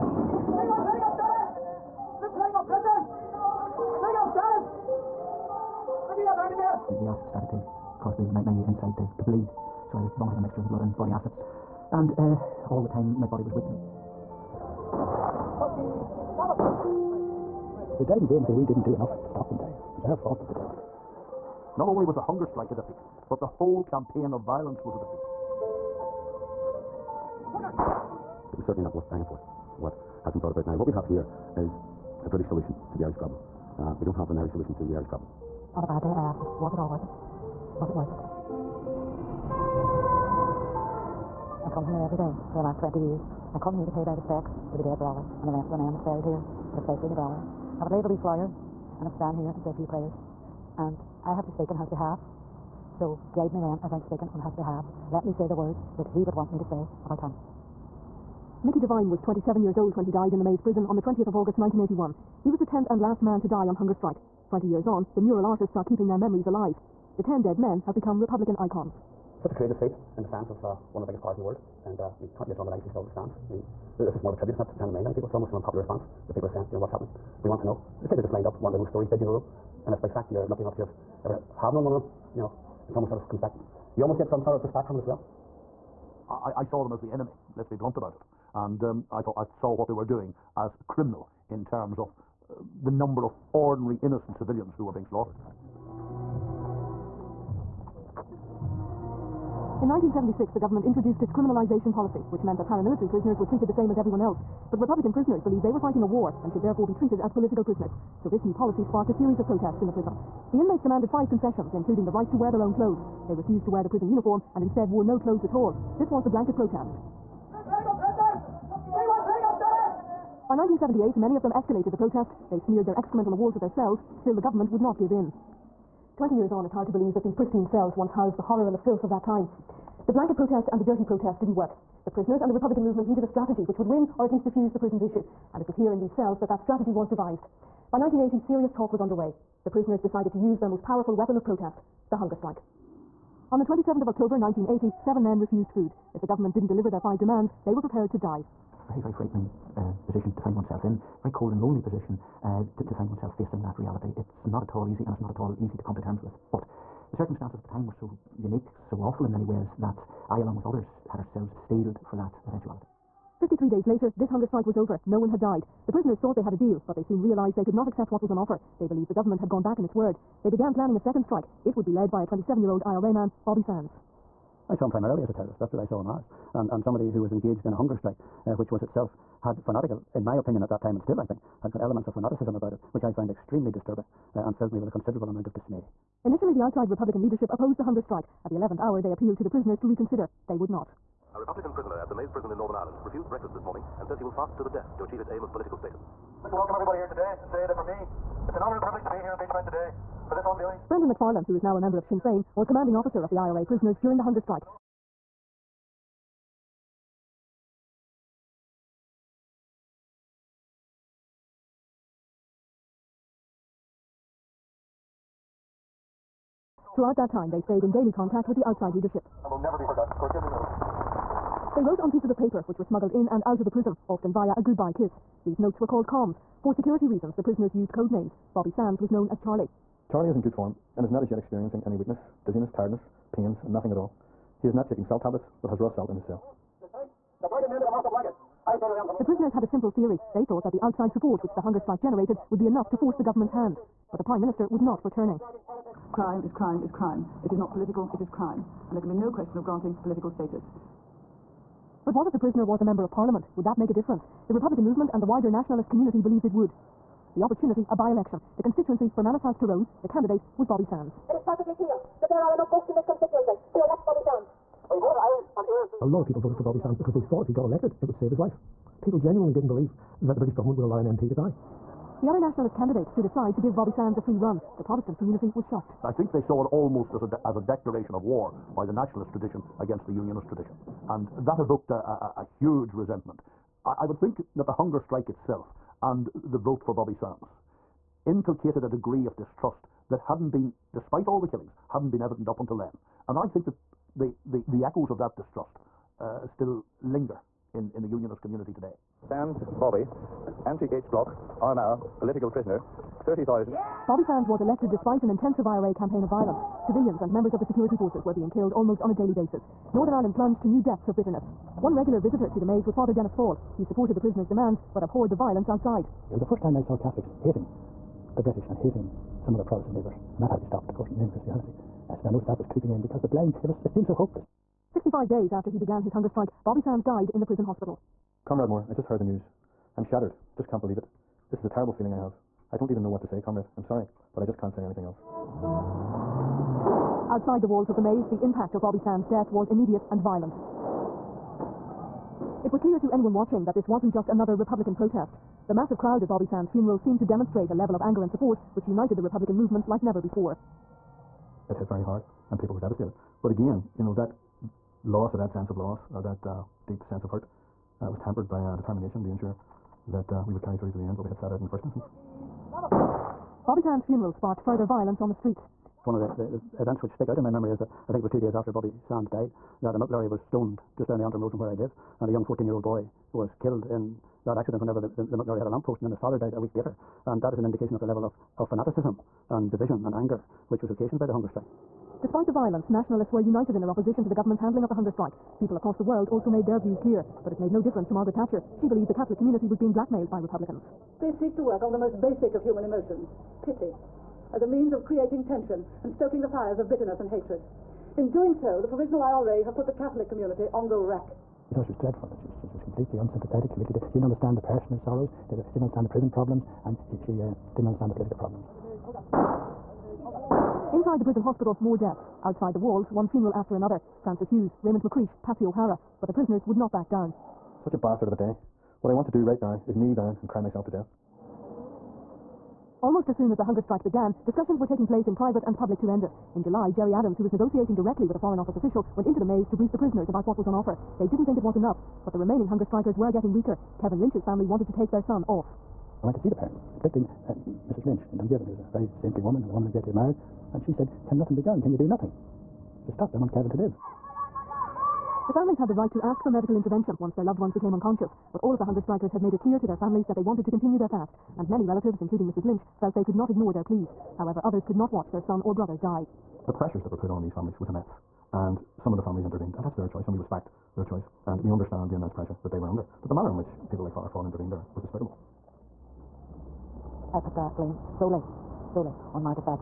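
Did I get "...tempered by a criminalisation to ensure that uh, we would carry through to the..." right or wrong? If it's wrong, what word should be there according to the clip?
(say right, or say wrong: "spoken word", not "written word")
wrong: "determination", not "criminalisation".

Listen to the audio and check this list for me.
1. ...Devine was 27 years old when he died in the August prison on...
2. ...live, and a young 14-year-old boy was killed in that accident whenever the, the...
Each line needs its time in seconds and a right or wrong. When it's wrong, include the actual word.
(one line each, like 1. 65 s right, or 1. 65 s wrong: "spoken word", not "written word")
1. 58 s wrong: "Maze", not "August"
2. 371 s right.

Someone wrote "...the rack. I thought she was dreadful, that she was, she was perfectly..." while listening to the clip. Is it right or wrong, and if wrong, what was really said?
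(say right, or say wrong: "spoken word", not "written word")
wrong: "completely", not "perfectly".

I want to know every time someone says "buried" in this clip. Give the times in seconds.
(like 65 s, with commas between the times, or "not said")
46 s.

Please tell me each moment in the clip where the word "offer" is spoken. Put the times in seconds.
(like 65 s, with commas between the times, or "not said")
168 s, 430 s.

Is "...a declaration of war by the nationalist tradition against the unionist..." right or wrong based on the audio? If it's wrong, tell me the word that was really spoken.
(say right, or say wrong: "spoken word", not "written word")
right.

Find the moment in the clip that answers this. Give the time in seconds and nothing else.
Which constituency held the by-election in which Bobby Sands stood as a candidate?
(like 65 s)
259 s.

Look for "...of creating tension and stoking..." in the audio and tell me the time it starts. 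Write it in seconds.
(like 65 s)
394 s.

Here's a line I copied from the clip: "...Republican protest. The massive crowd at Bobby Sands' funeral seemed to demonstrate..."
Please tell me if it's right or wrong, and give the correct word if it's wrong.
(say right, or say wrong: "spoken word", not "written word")
right.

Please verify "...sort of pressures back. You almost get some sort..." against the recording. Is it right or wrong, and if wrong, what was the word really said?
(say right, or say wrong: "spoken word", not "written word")
wrong: "comes", not "pressures".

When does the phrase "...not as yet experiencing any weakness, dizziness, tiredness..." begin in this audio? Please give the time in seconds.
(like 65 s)
231 s.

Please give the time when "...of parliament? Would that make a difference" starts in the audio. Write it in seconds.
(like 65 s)
253 s.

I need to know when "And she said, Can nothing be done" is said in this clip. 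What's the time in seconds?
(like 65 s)
440 s.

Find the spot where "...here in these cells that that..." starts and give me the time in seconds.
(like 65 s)
135 s.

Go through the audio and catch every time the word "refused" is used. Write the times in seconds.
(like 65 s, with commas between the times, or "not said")
113 s, 145 s, 193 s.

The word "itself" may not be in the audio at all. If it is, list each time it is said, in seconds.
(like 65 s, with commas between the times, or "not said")
178 s, 285 s.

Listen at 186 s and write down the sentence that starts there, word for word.
Initially, the outside Republican leadership opposed the hunger strike.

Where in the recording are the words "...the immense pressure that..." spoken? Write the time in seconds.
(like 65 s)
462 s.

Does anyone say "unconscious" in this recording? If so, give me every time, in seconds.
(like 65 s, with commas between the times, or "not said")
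447 s.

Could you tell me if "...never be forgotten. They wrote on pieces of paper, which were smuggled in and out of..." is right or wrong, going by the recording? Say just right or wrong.
right.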